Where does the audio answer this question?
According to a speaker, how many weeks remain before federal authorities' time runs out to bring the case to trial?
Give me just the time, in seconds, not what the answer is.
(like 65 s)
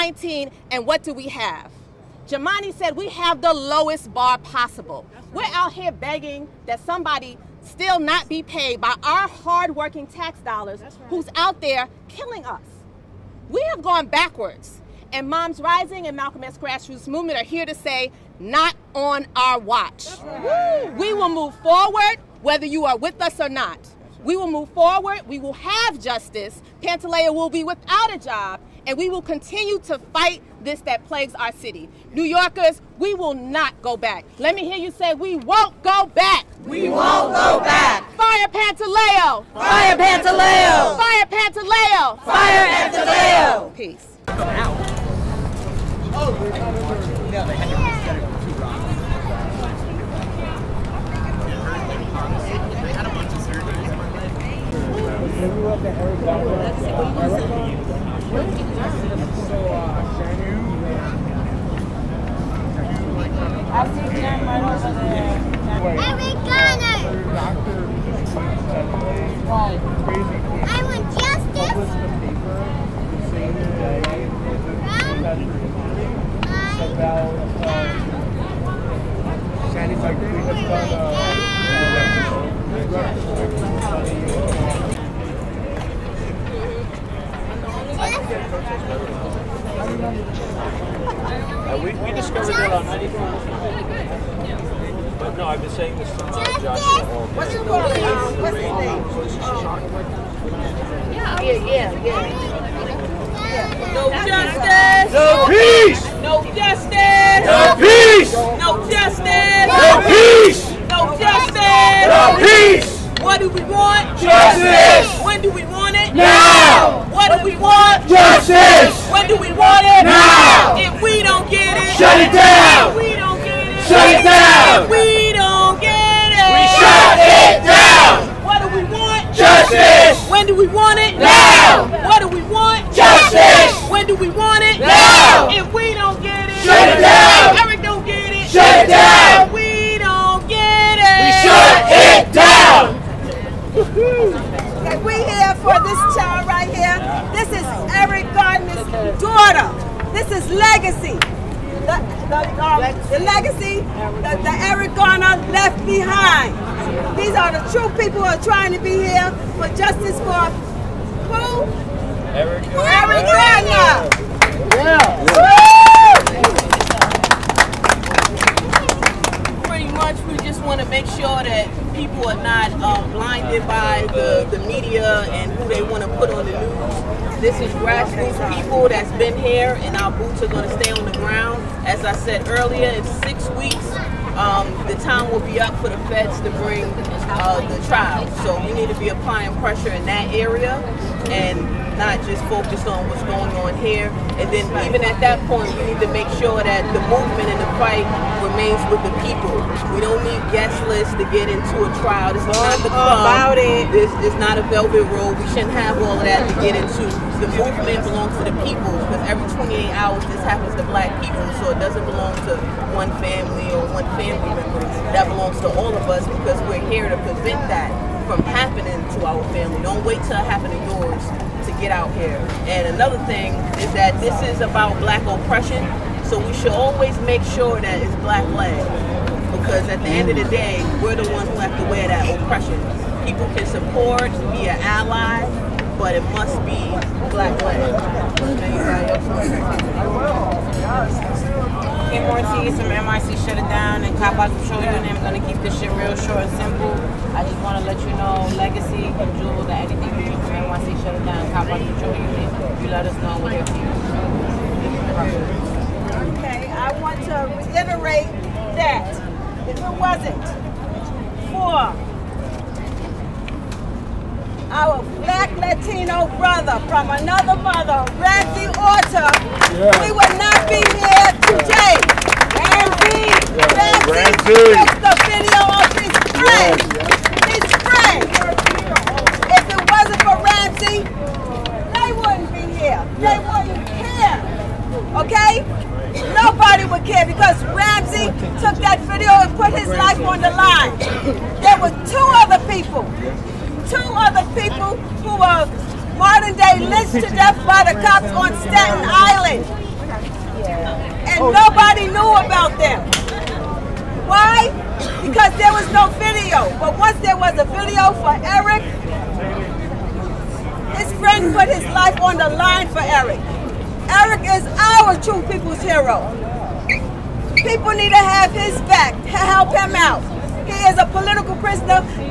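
183 s.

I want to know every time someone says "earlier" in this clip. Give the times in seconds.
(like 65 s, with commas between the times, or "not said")
182 s.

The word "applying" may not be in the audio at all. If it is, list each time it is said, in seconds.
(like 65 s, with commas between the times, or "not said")
189 s.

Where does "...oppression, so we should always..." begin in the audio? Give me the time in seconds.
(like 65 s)
225 s.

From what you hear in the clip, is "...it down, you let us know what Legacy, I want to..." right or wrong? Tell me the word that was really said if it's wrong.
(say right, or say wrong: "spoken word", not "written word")
wrong: "Okay", not "Legacy".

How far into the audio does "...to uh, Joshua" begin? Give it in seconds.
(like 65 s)
96 s.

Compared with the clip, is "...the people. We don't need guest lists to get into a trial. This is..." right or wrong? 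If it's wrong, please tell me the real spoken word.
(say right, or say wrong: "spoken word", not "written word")
right.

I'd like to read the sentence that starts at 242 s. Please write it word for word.
Kim Ortiz from MIC Shut It Down and Cop Out Control Unit.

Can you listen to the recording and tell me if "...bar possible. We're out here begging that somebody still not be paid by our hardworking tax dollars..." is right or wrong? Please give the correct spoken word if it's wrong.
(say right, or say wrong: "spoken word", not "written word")
right.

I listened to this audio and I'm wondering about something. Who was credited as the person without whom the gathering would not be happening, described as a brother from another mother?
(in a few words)
Randy Orta.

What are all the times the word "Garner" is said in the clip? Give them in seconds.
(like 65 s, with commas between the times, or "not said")
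154 s, 163 s.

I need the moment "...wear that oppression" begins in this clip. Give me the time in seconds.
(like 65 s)
231 s.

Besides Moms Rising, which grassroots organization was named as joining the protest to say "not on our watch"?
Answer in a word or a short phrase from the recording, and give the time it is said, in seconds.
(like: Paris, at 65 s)
Malcolm X Grassroots Movement, at 16 s.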